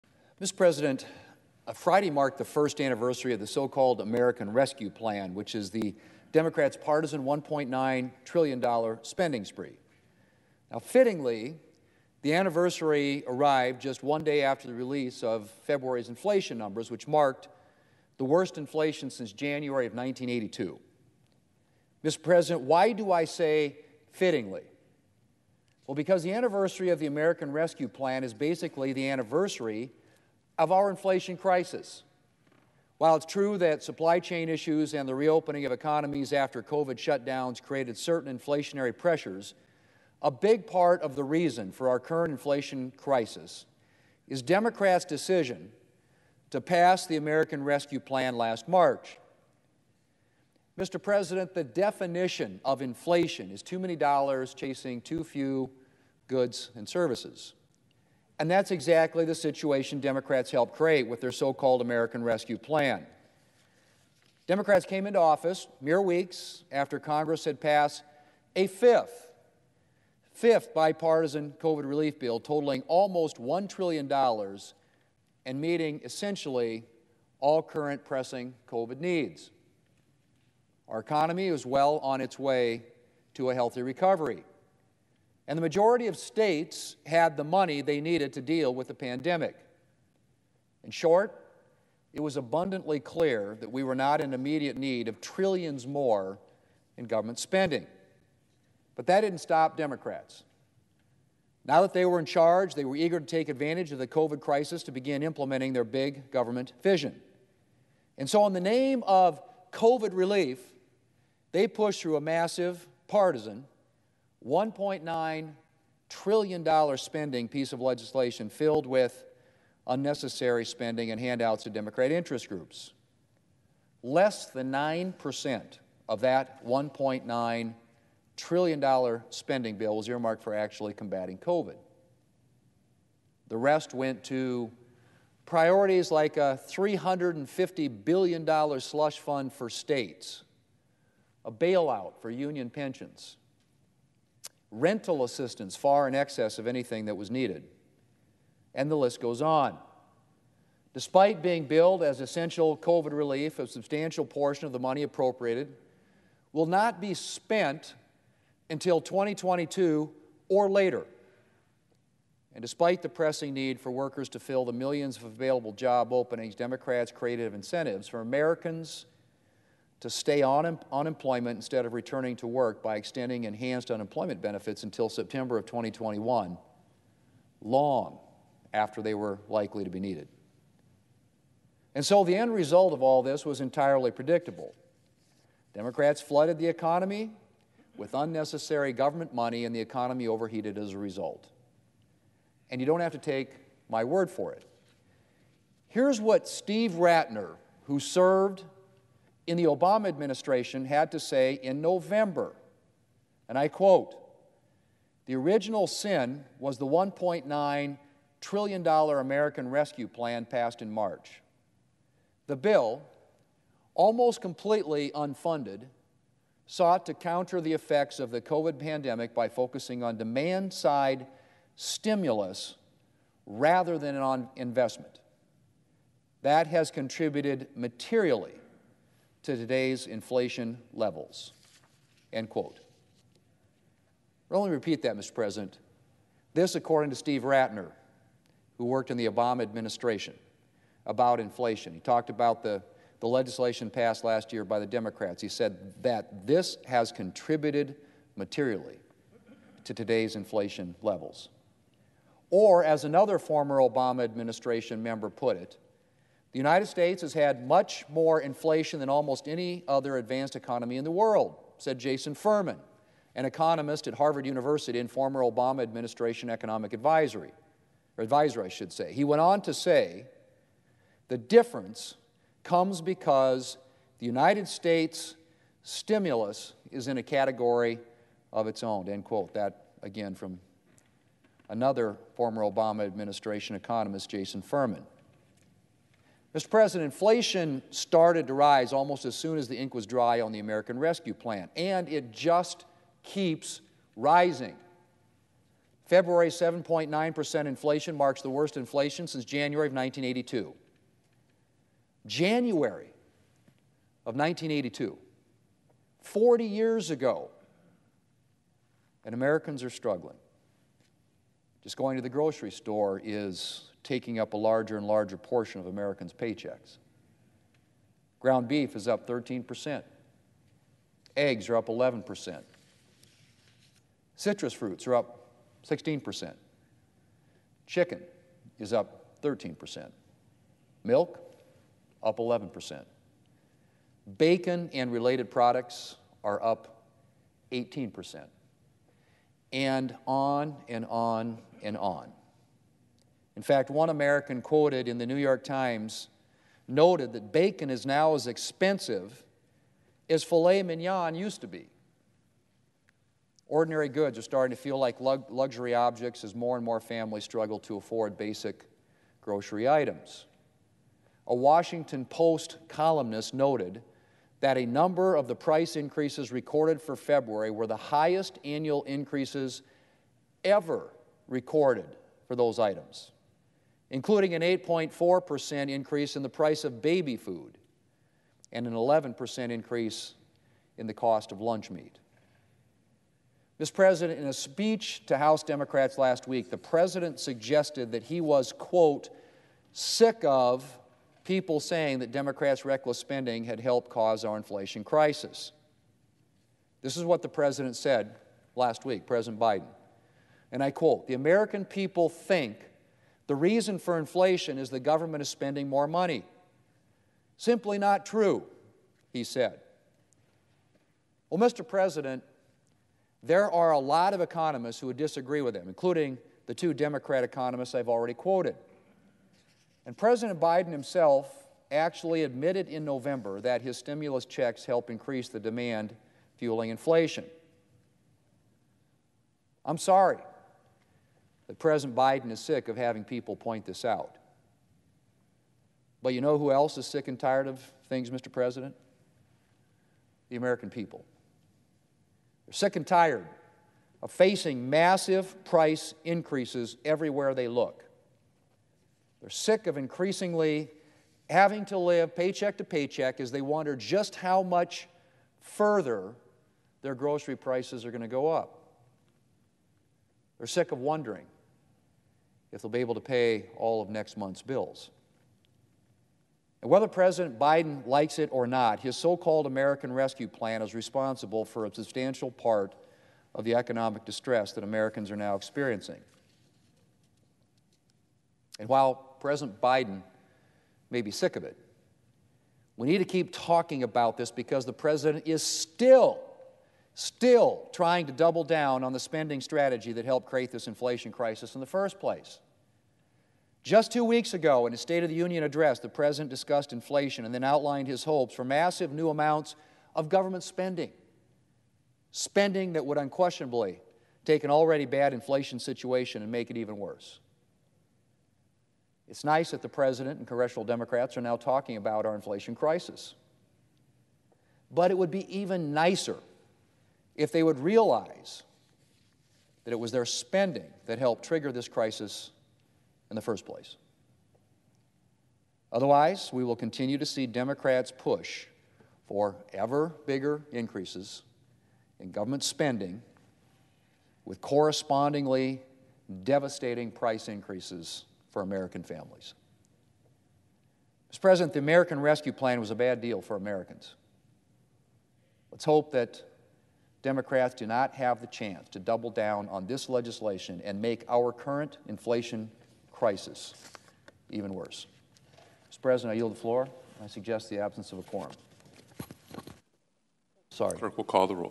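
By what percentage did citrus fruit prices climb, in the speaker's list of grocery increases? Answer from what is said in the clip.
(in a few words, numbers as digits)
16%.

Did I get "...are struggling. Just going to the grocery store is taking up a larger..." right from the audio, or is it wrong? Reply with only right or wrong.
right.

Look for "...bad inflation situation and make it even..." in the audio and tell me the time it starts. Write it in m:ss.
8:25.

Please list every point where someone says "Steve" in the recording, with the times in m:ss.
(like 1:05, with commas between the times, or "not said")
3:16, 3:57.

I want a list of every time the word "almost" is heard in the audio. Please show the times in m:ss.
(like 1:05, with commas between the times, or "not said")
1:12, 3:33, 4:19, 4:48.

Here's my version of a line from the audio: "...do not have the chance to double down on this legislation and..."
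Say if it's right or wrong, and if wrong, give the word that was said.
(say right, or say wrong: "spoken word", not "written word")
right.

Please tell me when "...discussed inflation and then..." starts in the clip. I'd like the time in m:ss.
8:16.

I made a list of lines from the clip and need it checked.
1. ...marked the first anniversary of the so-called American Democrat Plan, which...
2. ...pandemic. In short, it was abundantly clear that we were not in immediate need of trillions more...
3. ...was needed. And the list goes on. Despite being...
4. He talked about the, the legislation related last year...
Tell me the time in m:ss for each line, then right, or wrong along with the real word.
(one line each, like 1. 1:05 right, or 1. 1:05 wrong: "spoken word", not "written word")
1. 0:02 wrong: "Rescue", not "Democrat"
2. 1:28 right
3. 2:27 right
4. 4:01 wrong: "passed", not "related".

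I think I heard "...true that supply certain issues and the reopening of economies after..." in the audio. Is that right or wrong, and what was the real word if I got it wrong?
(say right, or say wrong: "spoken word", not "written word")
wrong: "chain", not "certain".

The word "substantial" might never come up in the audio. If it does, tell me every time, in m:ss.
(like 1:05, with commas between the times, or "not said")
2:33, 7:51.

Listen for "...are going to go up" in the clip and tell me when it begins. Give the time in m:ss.
7:38.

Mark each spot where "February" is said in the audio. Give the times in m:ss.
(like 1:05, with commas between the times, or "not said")
0:15, 4:56, 6:07.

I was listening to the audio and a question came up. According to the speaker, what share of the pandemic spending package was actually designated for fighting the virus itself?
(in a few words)
Less than 9%.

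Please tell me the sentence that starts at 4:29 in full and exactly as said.
He went on to say, the difference comes because the United States stimulus is in a category of its own, end quote.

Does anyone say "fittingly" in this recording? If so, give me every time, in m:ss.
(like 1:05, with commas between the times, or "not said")
0:10, 0:24.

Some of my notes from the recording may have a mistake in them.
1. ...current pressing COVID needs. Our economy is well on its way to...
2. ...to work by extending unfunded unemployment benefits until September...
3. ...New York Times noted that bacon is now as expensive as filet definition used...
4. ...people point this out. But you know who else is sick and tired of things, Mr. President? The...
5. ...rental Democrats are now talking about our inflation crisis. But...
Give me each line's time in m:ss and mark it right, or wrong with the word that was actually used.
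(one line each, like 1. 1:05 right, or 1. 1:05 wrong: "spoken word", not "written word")
1. 1:17 right
2. 2:52 wrong: "enhanced", not "unfunded"
3. 5:45 wrong: "mignon", not "definition"
4. 7:13 right
5. 8:30 wrong: "congressional", not "rental".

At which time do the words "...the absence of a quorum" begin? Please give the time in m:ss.
9:17.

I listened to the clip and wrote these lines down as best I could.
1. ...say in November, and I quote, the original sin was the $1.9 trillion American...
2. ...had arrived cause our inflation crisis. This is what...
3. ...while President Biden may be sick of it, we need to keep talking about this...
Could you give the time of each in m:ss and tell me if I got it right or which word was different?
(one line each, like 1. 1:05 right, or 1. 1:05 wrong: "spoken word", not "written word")
1. 3:21 right
2. 6:33 wrong: "helped", not "arrived"
3. 7:58 right.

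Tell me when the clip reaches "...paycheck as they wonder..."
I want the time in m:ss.
7:32.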